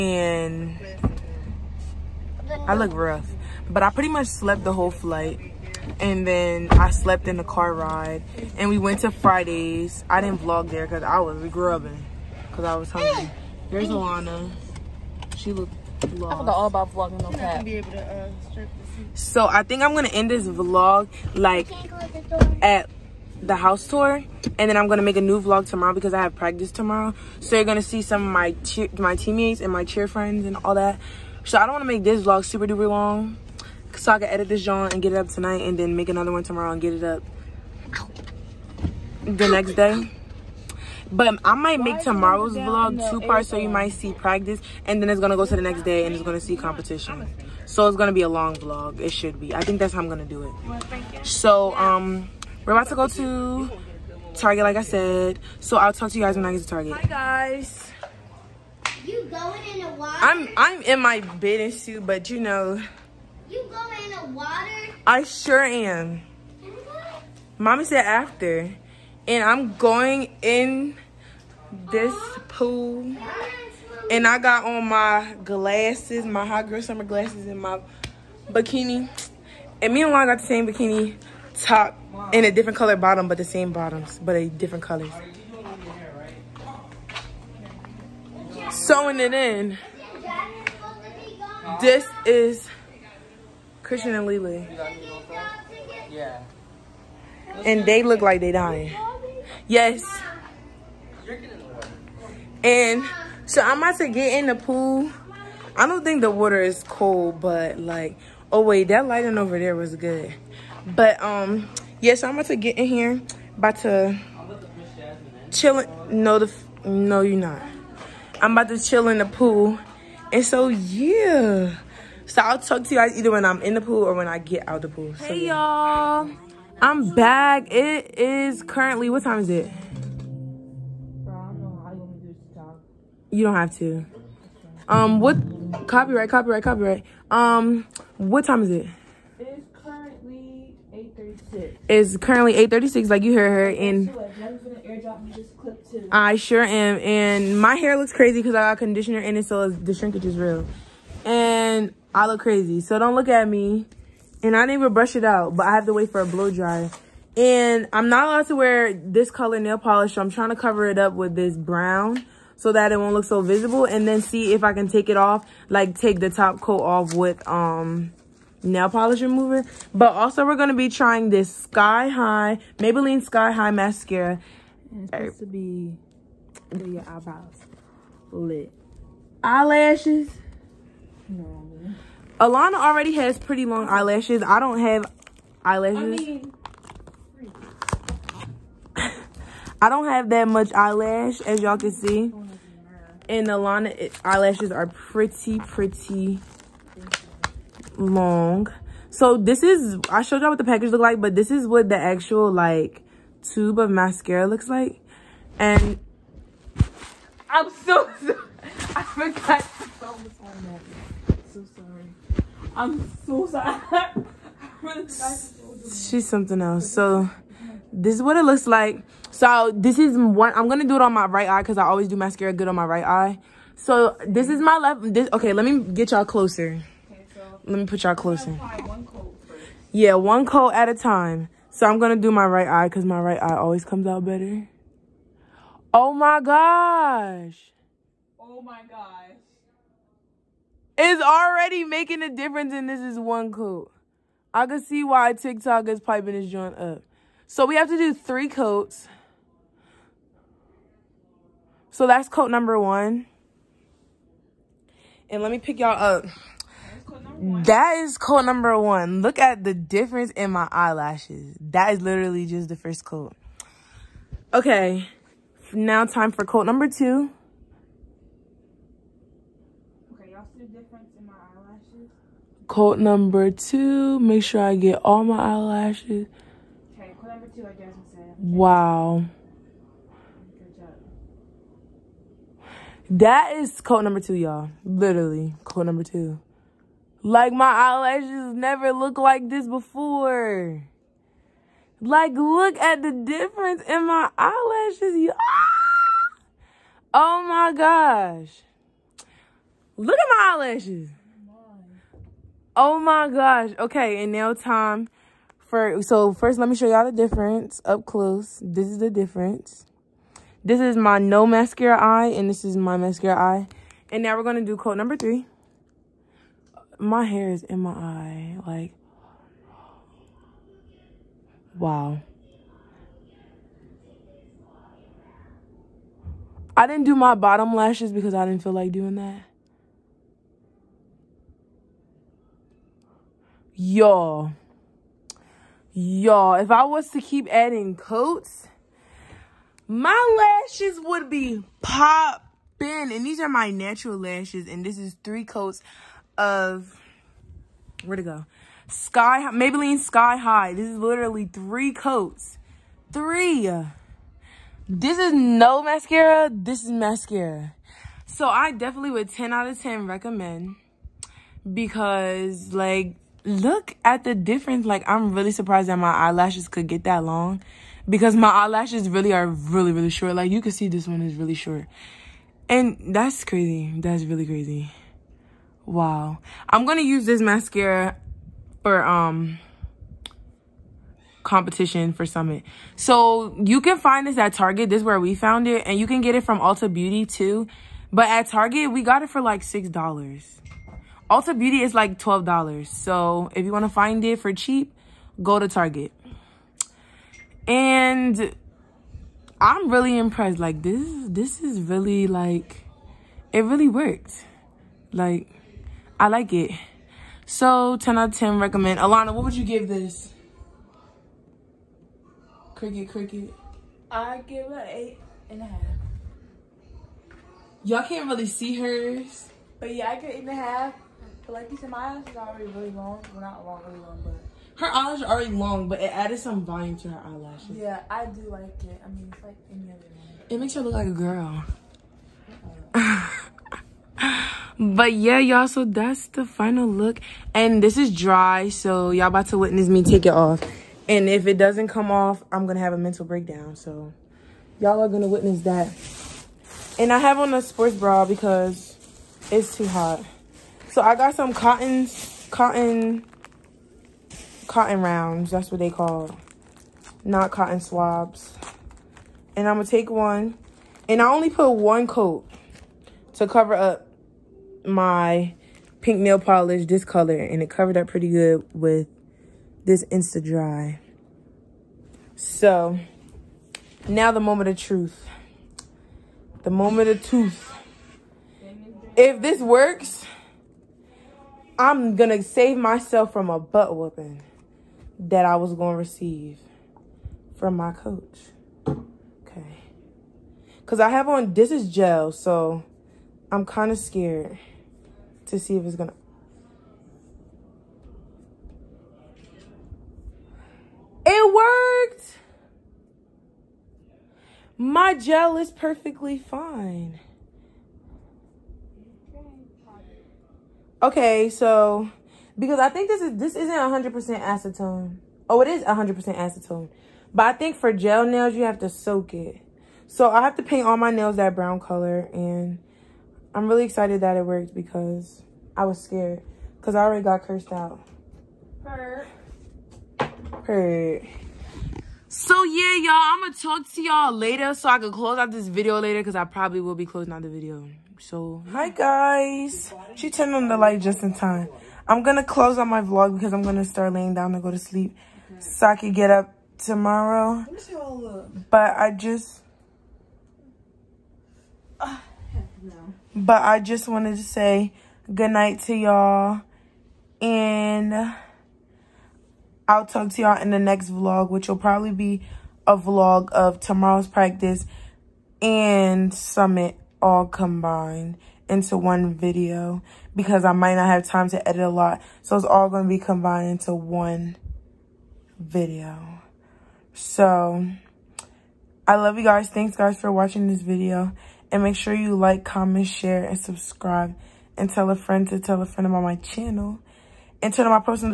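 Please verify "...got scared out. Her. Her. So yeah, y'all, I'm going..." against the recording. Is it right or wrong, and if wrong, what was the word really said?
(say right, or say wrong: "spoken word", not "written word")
wrong: "cursed", not "scared".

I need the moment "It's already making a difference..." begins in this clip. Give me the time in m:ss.
4:00.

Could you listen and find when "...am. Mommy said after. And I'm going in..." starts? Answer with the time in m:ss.
1:05.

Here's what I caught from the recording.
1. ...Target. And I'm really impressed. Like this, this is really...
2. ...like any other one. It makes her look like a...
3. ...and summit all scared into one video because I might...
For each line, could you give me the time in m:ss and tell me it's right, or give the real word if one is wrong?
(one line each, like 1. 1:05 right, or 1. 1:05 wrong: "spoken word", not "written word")
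1. 6:35 right
2. 7:09 right
3. 9:25 wrong: "combined", not "scared".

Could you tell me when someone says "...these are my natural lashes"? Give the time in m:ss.
5:43.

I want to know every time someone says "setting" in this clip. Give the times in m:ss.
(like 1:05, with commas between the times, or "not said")
not said.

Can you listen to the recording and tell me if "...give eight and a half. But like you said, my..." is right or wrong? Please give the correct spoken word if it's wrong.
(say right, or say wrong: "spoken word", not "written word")
right.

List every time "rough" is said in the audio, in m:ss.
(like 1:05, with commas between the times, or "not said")
0:02.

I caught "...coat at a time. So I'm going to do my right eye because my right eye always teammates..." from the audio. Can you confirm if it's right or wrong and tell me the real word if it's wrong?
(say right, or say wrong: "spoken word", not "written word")
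wrong: "comes", not "teammates".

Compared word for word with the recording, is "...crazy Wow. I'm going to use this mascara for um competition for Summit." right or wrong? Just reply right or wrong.
right.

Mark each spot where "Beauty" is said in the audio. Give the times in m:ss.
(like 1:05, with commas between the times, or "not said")
6:26, 6:31.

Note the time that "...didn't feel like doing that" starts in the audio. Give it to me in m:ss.
5:28.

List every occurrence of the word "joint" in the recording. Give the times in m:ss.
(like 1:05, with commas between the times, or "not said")
4:06.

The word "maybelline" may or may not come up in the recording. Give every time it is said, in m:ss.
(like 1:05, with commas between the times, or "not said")
2:52, 5:49.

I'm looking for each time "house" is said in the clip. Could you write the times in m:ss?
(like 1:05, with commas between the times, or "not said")
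0:23.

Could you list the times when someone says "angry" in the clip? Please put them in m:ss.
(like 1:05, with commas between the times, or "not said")
not said.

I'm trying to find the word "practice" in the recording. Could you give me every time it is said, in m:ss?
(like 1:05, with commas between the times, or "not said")
0:26, 0:44, 9:24.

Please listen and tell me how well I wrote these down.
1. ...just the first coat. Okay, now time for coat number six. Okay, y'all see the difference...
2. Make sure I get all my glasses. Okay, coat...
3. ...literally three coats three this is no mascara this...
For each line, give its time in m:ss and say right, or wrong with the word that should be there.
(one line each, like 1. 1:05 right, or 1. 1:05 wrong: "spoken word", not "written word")
1. 4:22 wrong: "two", not "six"
2. 4:34 wrong: "eyelashes", not "glasses"
3. 5:50 right.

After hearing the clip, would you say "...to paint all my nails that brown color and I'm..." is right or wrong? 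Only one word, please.
right.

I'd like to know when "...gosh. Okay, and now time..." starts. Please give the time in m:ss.
5:03.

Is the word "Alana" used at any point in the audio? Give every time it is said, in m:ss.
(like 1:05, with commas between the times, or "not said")
0:13, 3:02, 3:13, 6:48.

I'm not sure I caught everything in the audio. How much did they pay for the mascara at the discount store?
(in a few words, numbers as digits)
$6.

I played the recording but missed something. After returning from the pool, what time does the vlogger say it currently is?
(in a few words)
8:36.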